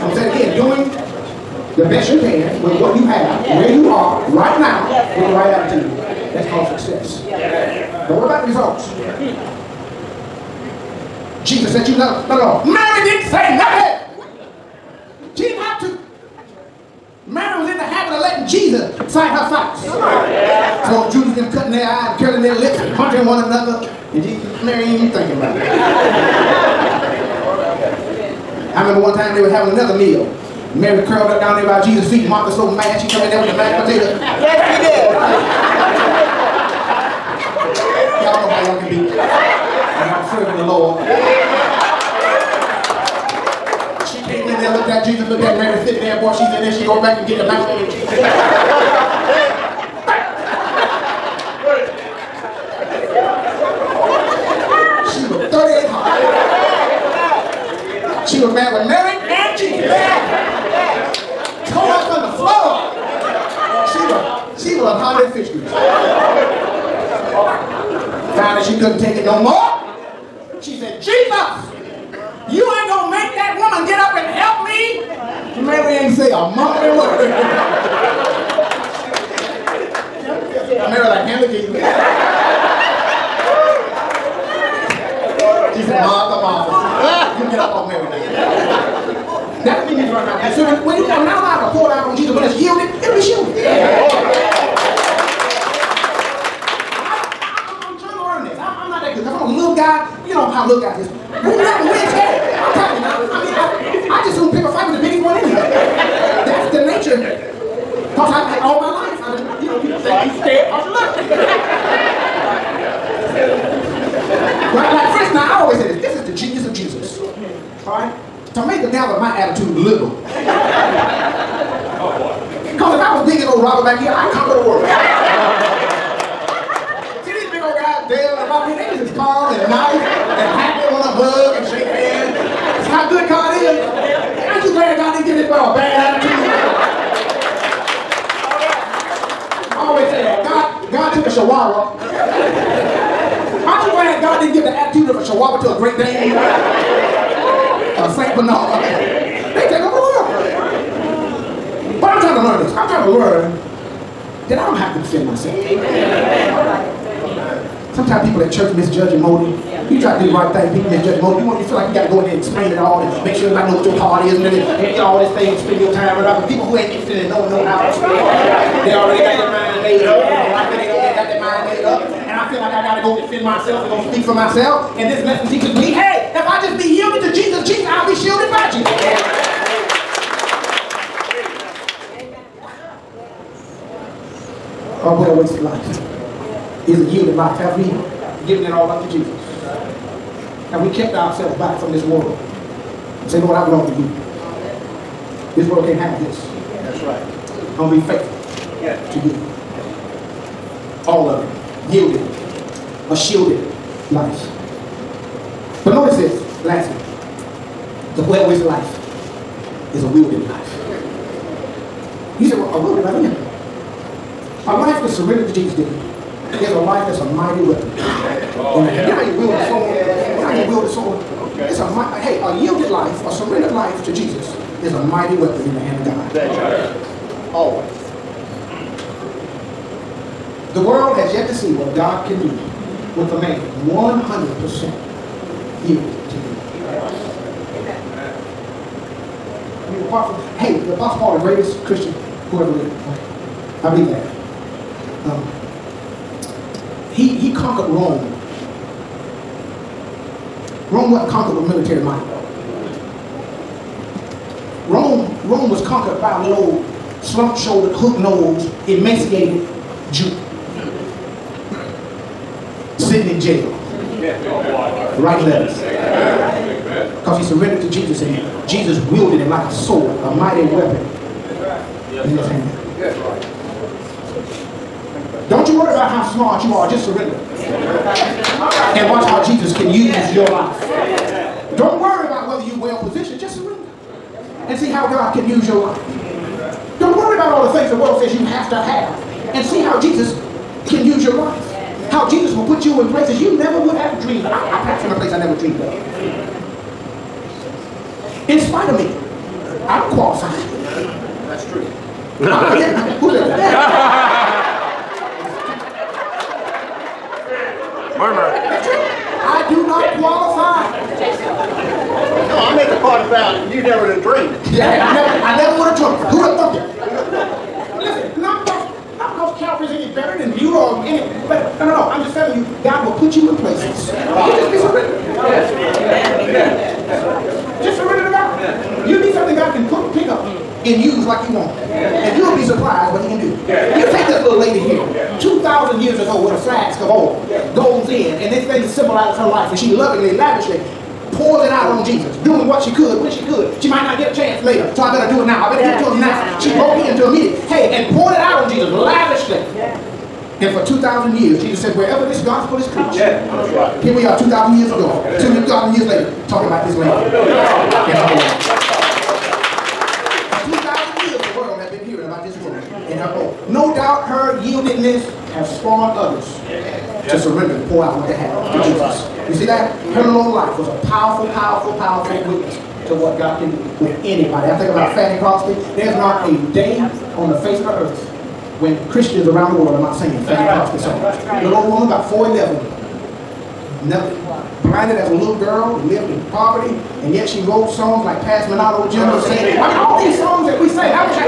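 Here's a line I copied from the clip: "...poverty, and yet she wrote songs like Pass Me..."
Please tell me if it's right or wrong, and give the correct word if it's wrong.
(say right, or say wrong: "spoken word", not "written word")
right.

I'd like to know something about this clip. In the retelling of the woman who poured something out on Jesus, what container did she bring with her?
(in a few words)
a flask of oil.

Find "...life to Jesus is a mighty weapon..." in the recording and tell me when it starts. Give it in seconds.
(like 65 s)
223 s.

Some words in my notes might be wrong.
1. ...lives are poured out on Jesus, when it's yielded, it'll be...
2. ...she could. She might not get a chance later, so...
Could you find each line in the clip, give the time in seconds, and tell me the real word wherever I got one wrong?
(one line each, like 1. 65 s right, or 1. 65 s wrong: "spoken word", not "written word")
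1. 91 s right
2. 343 s right.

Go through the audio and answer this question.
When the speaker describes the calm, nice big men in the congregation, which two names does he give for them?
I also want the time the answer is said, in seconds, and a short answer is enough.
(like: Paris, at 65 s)
Dale and Robbie, at 128 s.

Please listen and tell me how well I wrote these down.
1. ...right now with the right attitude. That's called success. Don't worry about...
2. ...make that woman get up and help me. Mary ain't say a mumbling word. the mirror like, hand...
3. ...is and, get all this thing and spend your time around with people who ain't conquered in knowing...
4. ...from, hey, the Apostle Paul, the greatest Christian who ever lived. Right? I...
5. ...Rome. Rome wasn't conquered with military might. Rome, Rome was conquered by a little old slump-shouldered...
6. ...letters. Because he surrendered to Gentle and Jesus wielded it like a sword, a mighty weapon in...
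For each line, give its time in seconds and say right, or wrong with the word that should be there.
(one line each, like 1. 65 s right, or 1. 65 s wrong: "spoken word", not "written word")
1. 4 s right
2. 73 s right
3. 164 s wrong: "interested", not "conquered"
4. 240 s right
5. 247 s right
6. 265 s wrong: "Jesus", not "Gentle".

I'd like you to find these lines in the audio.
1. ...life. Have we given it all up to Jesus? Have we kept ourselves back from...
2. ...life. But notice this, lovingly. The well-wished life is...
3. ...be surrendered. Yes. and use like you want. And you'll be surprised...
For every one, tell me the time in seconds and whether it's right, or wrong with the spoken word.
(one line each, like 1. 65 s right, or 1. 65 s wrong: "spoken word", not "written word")
1. 187 s right
2. 204 s wrong: "lastly", not "lovingly"
3. 324 s right.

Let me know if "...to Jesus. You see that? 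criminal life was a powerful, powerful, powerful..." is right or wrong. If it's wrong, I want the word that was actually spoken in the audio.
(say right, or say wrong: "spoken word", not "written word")
right.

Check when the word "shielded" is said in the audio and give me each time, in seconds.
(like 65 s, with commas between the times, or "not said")
93 s, 178 s, 203 s.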